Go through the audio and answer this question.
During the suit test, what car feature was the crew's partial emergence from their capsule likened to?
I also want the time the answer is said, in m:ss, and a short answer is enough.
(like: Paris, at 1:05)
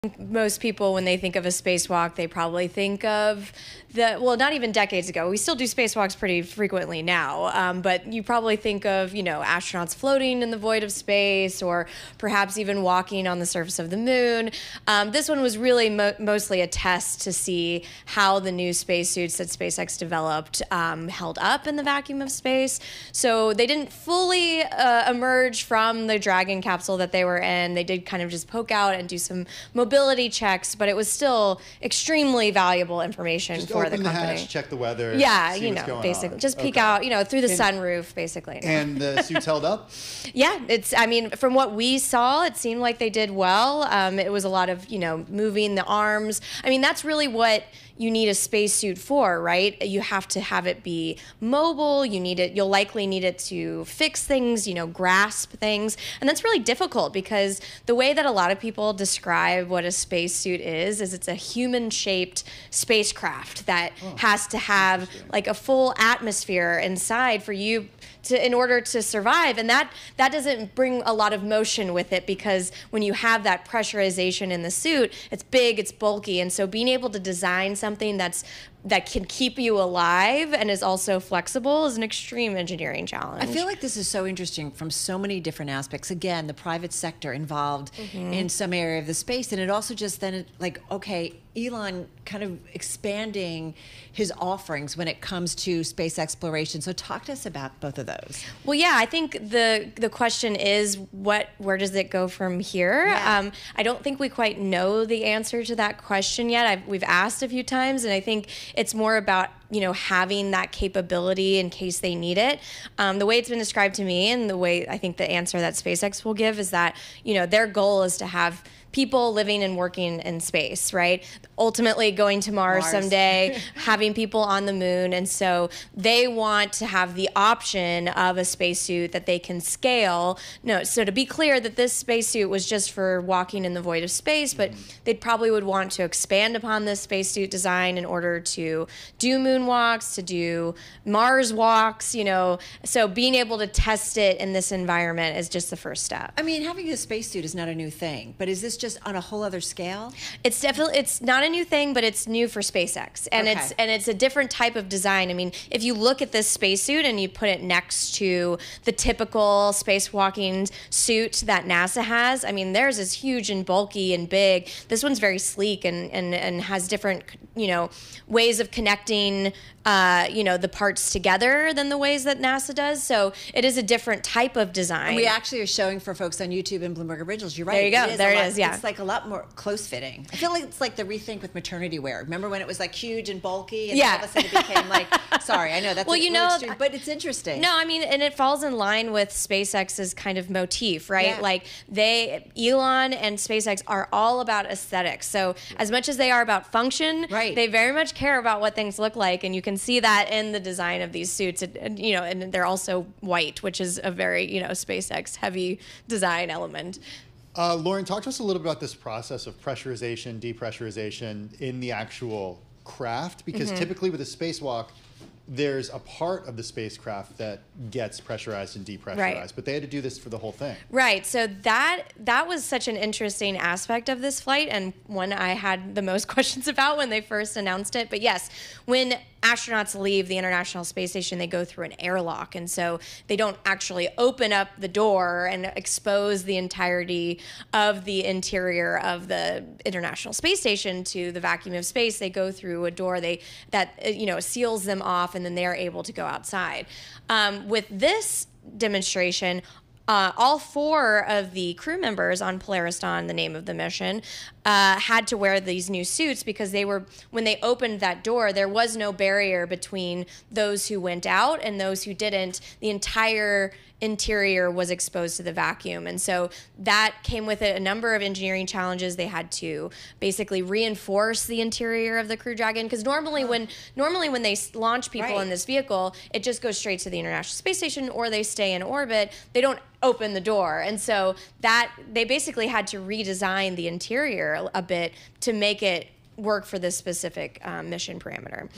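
sunroof, at 0:37.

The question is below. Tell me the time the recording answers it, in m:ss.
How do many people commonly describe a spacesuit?
1:01.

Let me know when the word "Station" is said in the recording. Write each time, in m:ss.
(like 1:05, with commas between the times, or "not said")
3:51, 4:00, 4:37.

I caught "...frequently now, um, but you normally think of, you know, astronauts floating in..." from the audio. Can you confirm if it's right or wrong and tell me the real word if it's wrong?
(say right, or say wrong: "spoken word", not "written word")
wrong: "probably", not "normally".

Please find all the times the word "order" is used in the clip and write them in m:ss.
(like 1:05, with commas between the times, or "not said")
1:08, 2:18.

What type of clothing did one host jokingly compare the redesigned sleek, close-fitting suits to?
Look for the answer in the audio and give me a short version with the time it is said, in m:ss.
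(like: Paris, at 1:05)
maternity wear, at 3:01.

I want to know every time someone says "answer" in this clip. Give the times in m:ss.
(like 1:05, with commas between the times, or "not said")
1:45, 1:55.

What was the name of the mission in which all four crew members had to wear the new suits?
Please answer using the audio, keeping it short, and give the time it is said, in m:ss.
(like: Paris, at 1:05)
Polaris Dawn, at 4:12.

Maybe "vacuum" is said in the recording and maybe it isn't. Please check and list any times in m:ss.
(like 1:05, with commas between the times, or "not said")
0:21, 4:01, 4:25.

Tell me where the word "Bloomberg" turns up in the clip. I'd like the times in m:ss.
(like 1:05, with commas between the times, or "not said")
2:56.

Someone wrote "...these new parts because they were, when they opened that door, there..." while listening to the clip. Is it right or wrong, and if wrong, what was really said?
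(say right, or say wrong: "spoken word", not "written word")
wrong: "suits", not "parts".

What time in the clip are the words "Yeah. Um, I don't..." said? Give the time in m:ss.
1:43.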